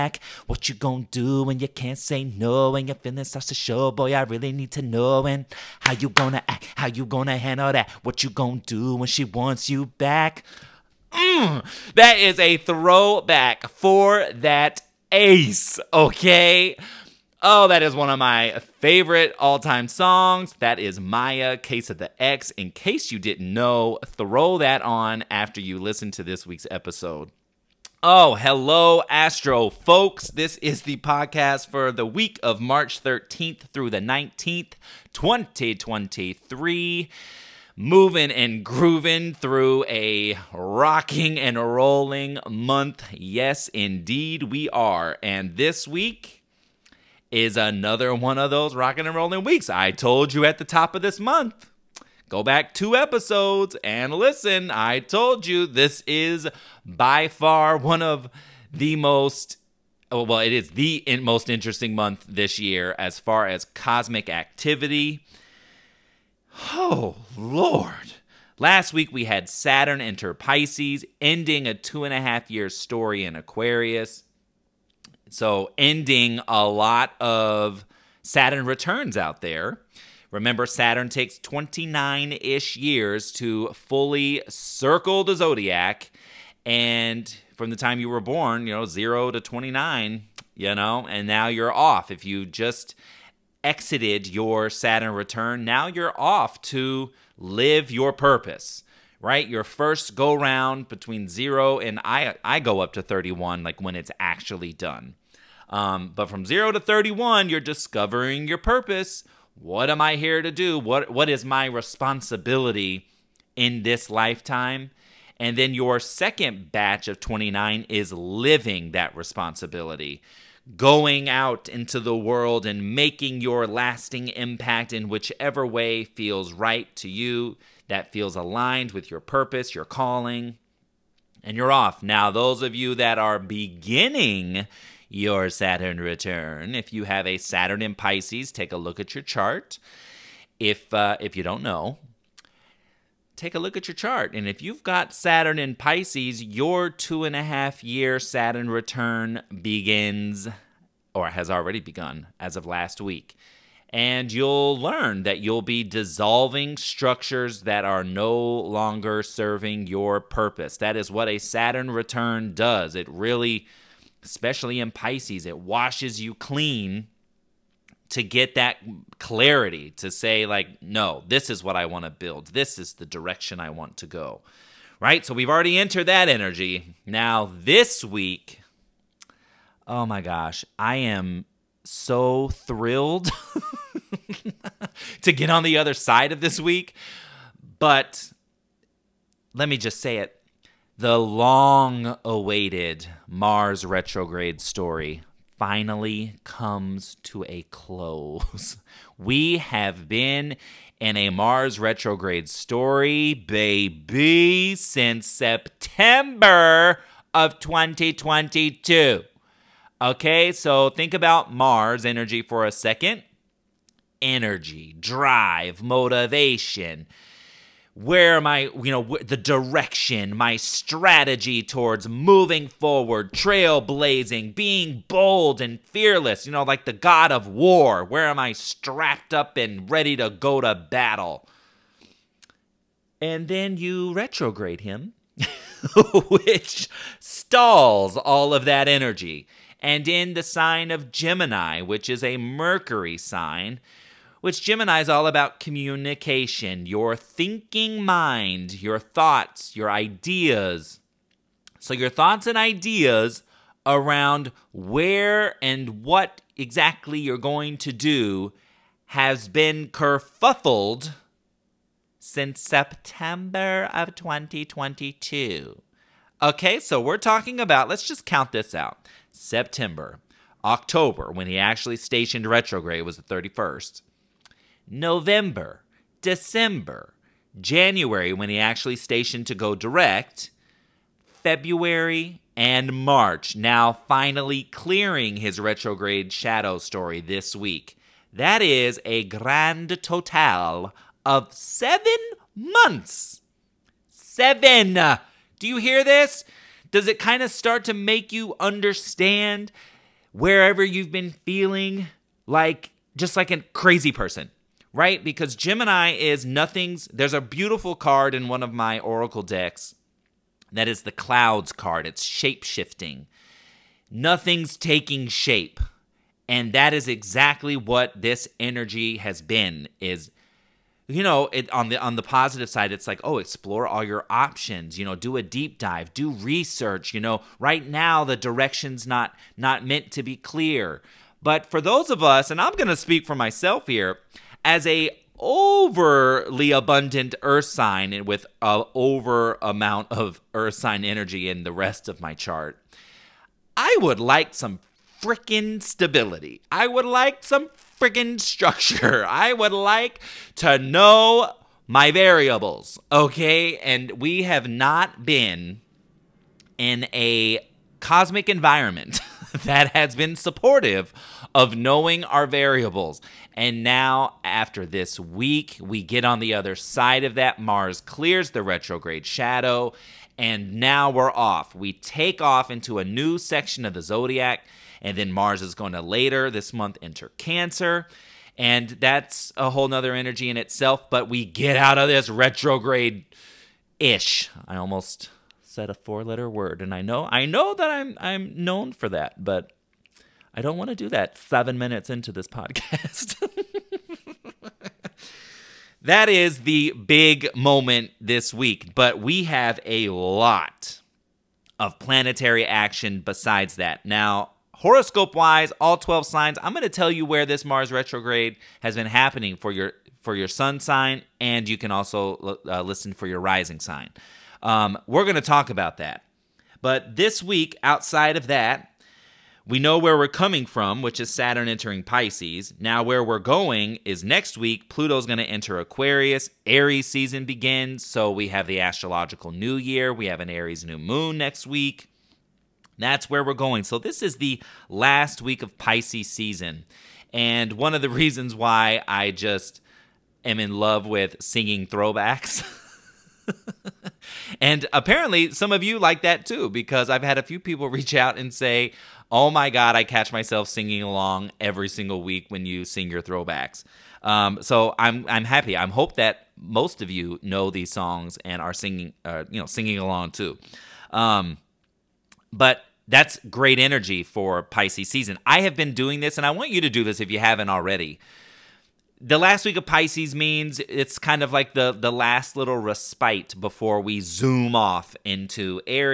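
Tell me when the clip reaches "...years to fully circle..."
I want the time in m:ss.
1:22.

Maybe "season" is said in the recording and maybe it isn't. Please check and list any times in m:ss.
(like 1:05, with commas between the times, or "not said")
7:07, 7:16, 7:45.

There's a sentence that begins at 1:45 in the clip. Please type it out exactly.
Um, but from zero to 31, you're discovering your purpose.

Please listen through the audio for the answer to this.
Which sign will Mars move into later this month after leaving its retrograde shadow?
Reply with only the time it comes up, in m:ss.
6:17.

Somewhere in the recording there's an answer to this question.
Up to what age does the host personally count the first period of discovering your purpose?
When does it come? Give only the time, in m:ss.
1:42.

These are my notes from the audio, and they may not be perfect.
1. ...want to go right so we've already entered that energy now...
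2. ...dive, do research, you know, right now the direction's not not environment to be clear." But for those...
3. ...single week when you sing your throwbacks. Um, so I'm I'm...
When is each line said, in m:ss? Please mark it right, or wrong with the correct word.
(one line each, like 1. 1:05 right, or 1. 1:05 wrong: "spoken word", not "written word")
1. 2:53 right
2. 5:25 wrong: "meant", not "environment"
3. 7:31 right.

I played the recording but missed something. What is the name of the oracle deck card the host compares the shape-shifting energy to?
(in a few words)
Clouds card.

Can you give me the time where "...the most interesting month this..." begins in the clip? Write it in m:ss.
1:00.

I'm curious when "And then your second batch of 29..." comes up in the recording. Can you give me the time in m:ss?
1:55.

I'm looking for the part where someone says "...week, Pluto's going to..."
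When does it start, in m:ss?
7:04.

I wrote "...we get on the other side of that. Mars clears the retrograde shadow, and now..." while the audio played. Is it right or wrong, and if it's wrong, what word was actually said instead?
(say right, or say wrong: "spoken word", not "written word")
right.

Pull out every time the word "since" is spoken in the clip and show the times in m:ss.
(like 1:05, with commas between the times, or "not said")
3:24, 4:22.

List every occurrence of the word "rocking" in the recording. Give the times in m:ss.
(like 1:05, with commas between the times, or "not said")
0:40, 0:48.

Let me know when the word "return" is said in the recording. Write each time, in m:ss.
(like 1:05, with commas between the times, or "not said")
1:18, 1:35, 2:16, 2:28, 2:41.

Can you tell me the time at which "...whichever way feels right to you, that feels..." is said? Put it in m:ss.
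2:05.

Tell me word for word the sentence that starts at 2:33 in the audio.
And you'll learn that you'll be dissolving structures that are no longer serving your purpose.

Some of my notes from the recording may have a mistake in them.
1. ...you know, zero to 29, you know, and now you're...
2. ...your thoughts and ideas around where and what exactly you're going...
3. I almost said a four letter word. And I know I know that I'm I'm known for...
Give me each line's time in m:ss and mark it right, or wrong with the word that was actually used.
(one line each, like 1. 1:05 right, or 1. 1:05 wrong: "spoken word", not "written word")
1. 1:28 right
2. 4:11 right
3. 6:24 right.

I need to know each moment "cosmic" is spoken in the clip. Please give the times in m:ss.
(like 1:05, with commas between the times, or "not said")
1:03, 5:58.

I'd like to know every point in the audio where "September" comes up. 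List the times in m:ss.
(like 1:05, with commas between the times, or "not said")
3:25, 4:22, 4:29.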